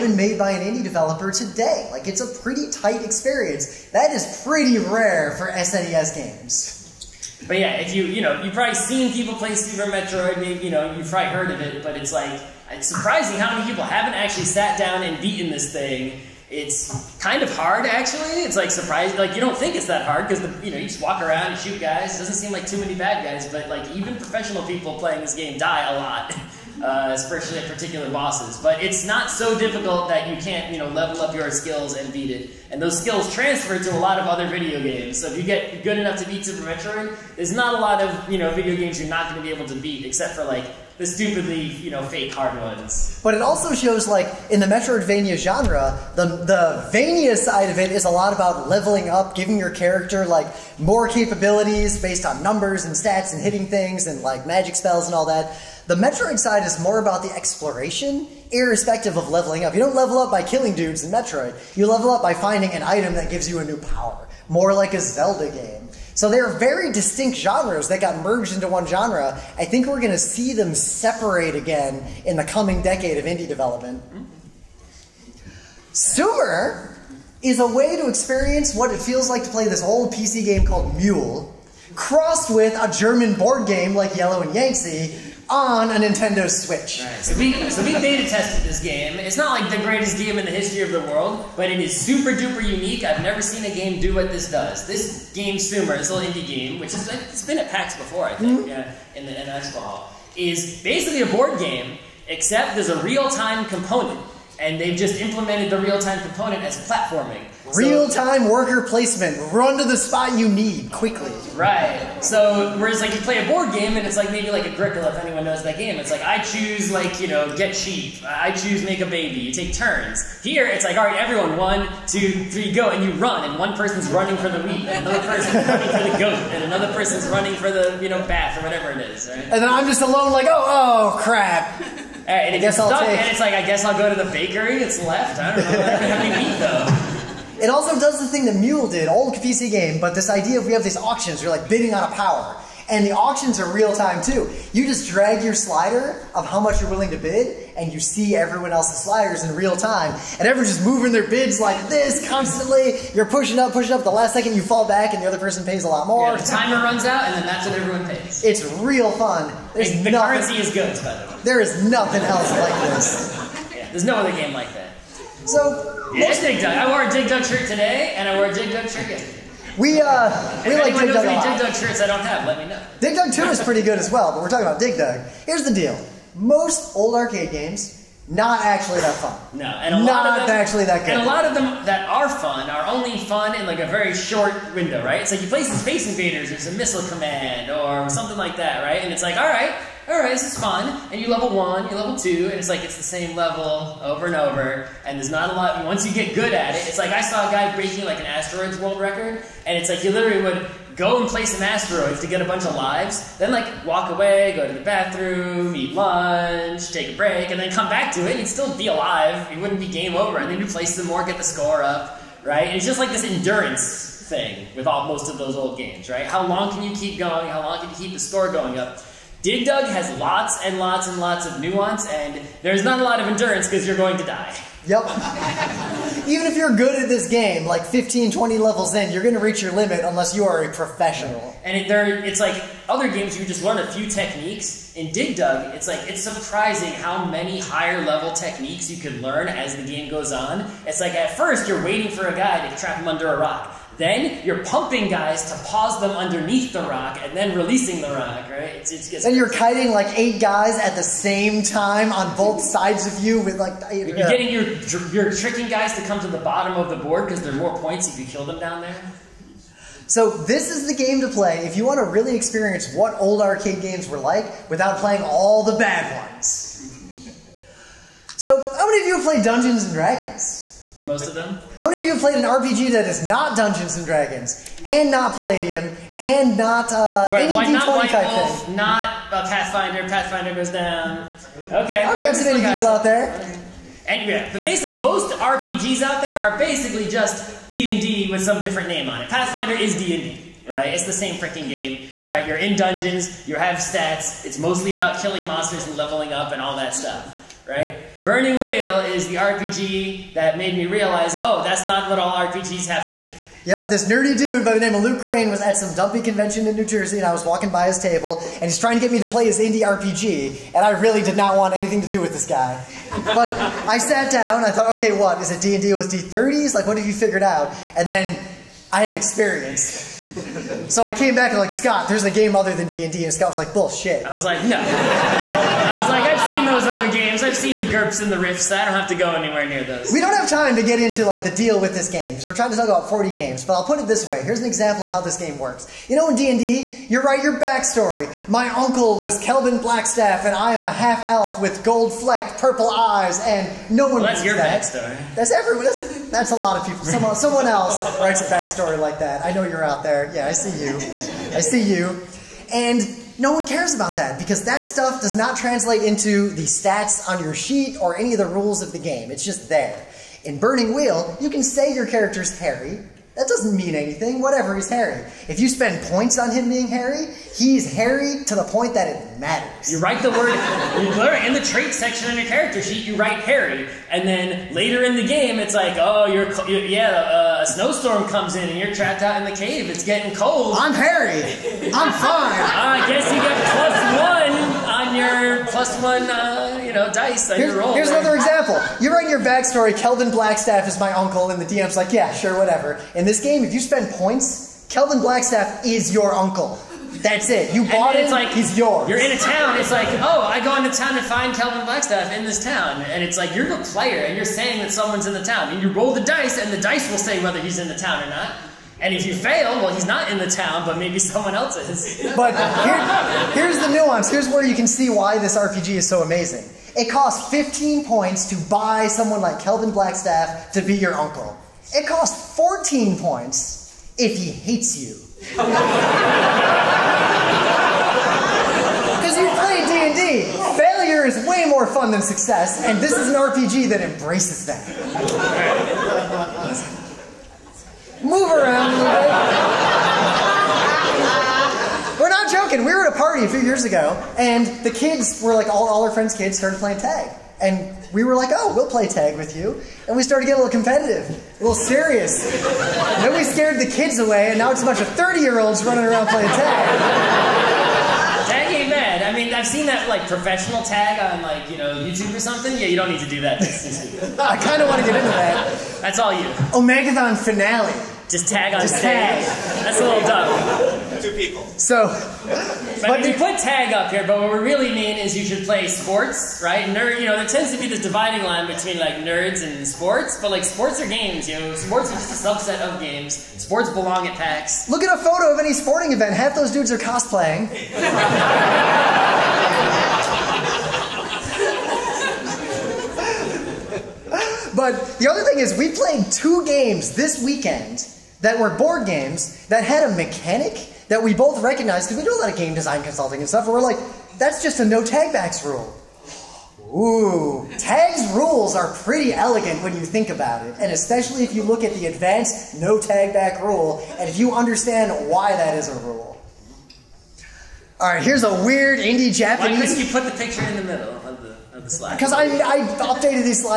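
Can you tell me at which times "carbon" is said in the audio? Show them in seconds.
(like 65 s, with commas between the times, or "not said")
not said.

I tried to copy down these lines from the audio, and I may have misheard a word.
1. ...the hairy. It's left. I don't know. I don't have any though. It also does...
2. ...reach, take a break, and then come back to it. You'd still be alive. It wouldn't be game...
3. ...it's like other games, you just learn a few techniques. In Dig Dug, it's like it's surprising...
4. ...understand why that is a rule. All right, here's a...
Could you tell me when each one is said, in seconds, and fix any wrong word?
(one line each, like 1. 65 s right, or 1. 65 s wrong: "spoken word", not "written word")
1. 134 s wrong: "bakery", not "hairy"
2. 205 s wrong: "lunch", not "reach"
3. 232 s right
4. 514 s right.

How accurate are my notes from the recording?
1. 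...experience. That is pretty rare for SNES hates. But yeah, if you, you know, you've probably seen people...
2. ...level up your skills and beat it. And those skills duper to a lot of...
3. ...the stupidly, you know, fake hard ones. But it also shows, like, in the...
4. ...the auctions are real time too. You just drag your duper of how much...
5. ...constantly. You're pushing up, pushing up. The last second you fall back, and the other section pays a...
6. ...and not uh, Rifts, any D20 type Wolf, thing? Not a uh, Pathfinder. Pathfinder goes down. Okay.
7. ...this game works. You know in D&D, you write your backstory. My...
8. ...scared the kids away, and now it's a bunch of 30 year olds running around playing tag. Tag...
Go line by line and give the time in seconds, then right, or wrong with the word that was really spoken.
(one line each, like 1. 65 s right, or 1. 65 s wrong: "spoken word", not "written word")
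1. 3 s wrong: "games", not "hates"
2. 30 s wrong: "transfer", not "duper"
3. 41 s right
4. 143 s wrong: "slider", not "duper"
5. 152 s wrong: "person", not "section"
6. 276 s wrong: "Wait", not "Rifts"
7. 335 s right
8. 453 s right.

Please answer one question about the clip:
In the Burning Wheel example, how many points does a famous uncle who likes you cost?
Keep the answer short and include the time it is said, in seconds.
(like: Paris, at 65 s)
15, at 417 s.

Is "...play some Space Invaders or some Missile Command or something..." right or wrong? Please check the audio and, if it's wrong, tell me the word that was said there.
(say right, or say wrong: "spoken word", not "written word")
right.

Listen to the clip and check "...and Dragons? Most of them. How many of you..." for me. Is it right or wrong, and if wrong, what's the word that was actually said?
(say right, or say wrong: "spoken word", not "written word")
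right.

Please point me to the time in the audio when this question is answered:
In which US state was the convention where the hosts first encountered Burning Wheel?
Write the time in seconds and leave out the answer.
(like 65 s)
306 s.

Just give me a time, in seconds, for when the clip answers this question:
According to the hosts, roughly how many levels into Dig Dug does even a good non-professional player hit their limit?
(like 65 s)
227 s.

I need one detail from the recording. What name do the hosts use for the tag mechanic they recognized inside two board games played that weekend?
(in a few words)
no tag backs rule.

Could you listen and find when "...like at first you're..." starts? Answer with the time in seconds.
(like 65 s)
240 s.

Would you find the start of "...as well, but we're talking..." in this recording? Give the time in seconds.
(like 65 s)
173 s.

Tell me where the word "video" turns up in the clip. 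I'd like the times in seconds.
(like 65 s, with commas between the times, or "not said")
34 s, 38 s.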